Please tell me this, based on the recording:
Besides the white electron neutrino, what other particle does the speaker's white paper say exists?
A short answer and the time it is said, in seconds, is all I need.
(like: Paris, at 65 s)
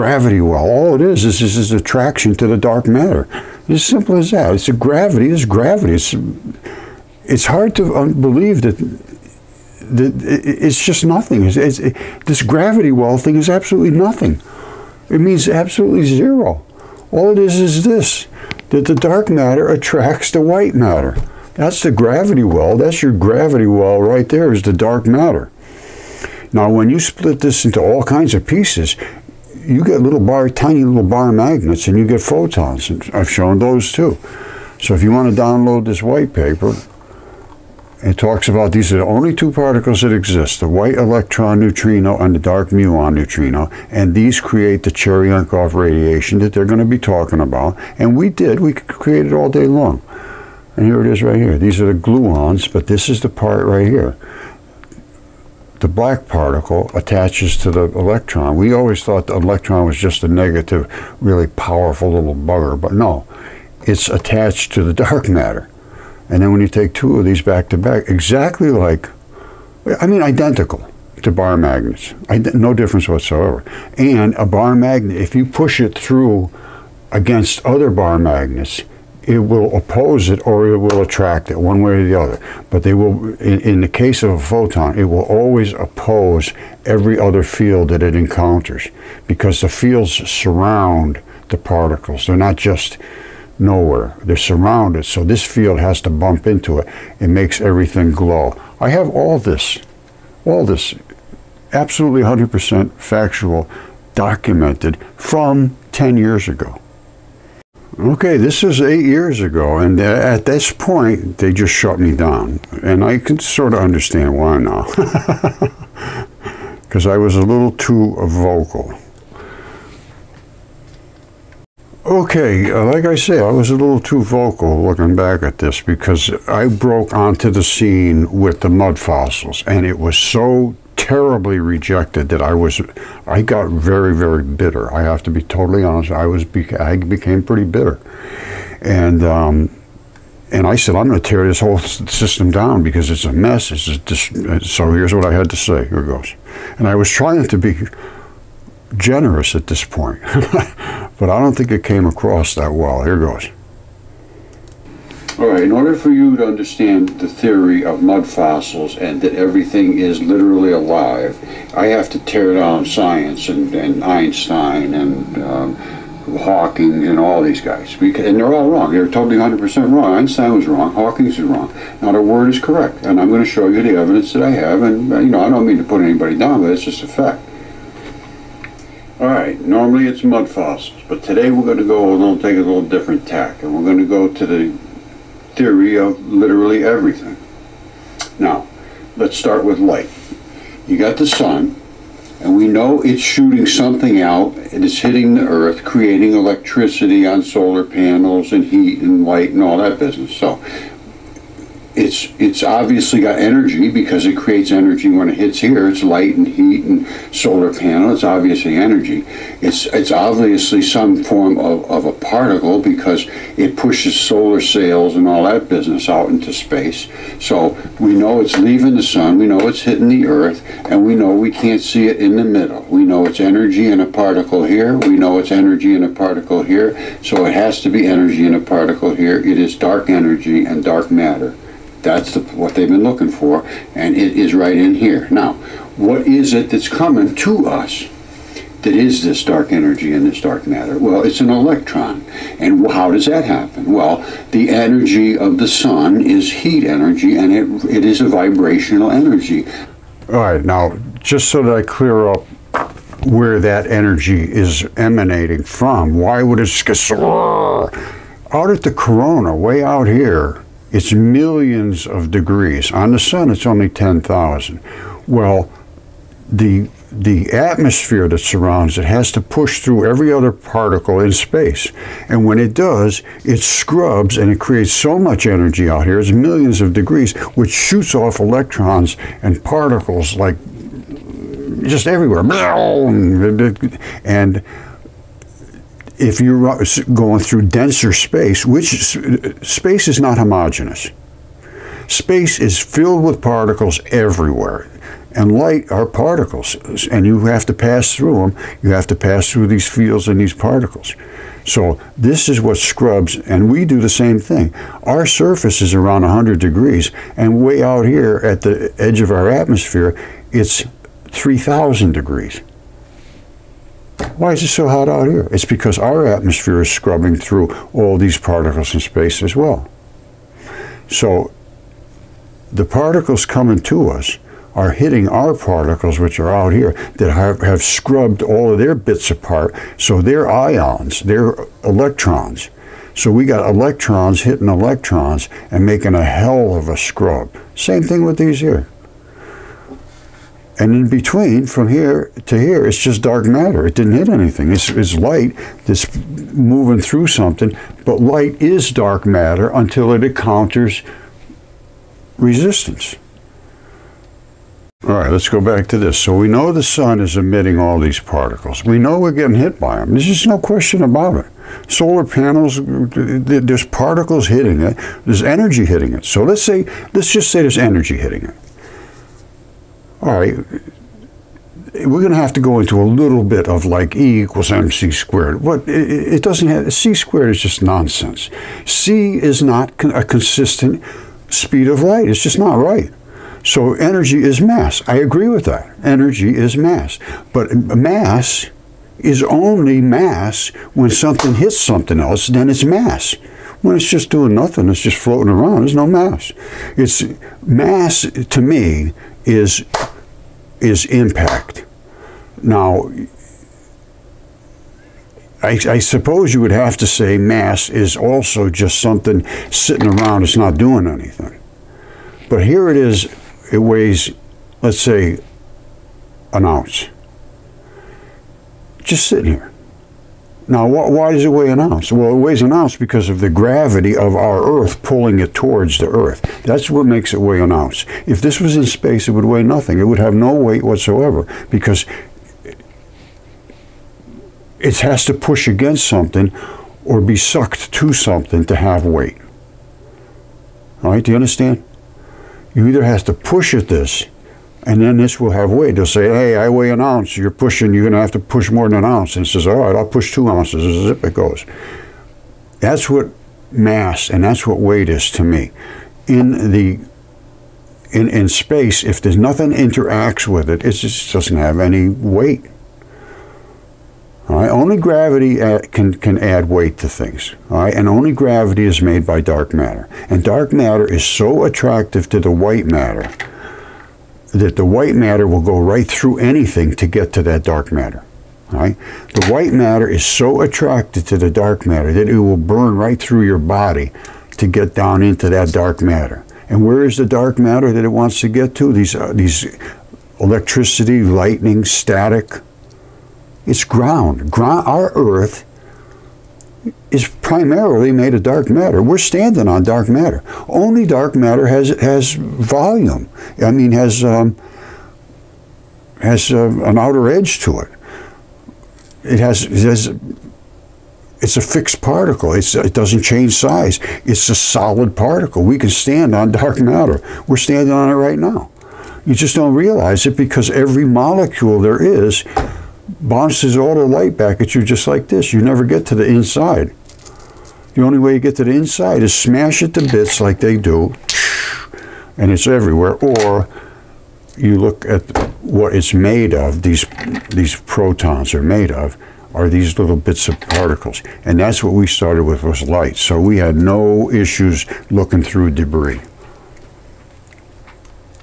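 dark muon neutrino, at 42 s.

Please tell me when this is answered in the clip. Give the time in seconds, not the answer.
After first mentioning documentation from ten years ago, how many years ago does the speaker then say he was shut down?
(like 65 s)
108 s.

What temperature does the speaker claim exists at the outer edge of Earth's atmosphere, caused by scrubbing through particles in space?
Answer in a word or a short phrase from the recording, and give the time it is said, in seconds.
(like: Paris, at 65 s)
3,000 degrees, at 311 s.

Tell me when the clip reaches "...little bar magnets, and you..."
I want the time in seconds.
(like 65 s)
30 s.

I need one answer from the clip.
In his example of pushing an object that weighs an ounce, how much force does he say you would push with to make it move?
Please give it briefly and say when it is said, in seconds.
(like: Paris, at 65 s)
2 ounces, at 450 s.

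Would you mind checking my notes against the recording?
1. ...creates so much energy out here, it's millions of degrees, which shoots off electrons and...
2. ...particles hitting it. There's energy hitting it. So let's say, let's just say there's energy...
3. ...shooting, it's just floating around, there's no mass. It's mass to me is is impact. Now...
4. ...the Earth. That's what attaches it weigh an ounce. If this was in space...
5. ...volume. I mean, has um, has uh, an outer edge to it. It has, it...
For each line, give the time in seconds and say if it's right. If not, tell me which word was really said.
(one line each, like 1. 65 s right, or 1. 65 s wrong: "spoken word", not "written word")
1. 274 s right
2. 363 s right
3. 394 s wrong: "nothing", not "shooting"
4. 425 s wrong: "makes", not "attaches"
5. 502 s right.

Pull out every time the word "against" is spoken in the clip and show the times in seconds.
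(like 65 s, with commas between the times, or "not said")
77 s, 435 s.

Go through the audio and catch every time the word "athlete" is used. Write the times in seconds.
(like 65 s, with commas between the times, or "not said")
not said.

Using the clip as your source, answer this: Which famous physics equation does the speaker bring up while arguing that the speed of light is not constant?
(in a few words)
E equals mc squared.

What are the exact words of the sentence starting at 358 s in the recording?
We know we're getting hit by them.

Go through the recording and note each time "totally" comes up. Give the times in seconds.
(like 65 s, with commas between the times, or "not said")
135 s, 169 s.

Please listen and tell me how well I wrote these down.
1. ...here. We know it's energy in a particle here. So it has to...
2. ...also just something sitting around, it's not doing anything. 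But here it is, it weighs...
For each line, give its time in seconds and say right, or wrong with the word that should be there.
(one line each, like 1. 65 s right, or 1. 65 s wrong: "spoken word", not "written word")
1. 224 s right
2. 408 s right.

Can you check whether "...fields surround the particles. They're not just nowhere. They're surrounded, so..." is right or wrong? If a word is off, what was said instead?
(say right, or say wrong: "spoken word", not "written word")
right.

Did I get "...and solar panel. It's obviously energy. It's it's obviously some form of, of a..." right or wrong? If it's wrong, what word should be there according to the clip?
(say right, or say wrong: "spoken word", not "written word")
right.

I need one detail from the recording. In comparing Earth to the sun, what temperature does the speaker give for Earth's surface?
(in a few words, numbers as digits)
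100 degrees.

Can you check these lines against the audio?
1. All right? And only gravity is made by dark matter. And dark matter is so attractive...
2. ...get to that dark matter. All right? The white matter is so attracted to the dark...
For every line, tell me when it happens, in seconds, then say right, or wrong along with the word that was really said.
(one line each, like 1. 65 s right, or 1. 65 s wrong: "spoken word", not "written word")
1. 467 s right
2. 477 s right.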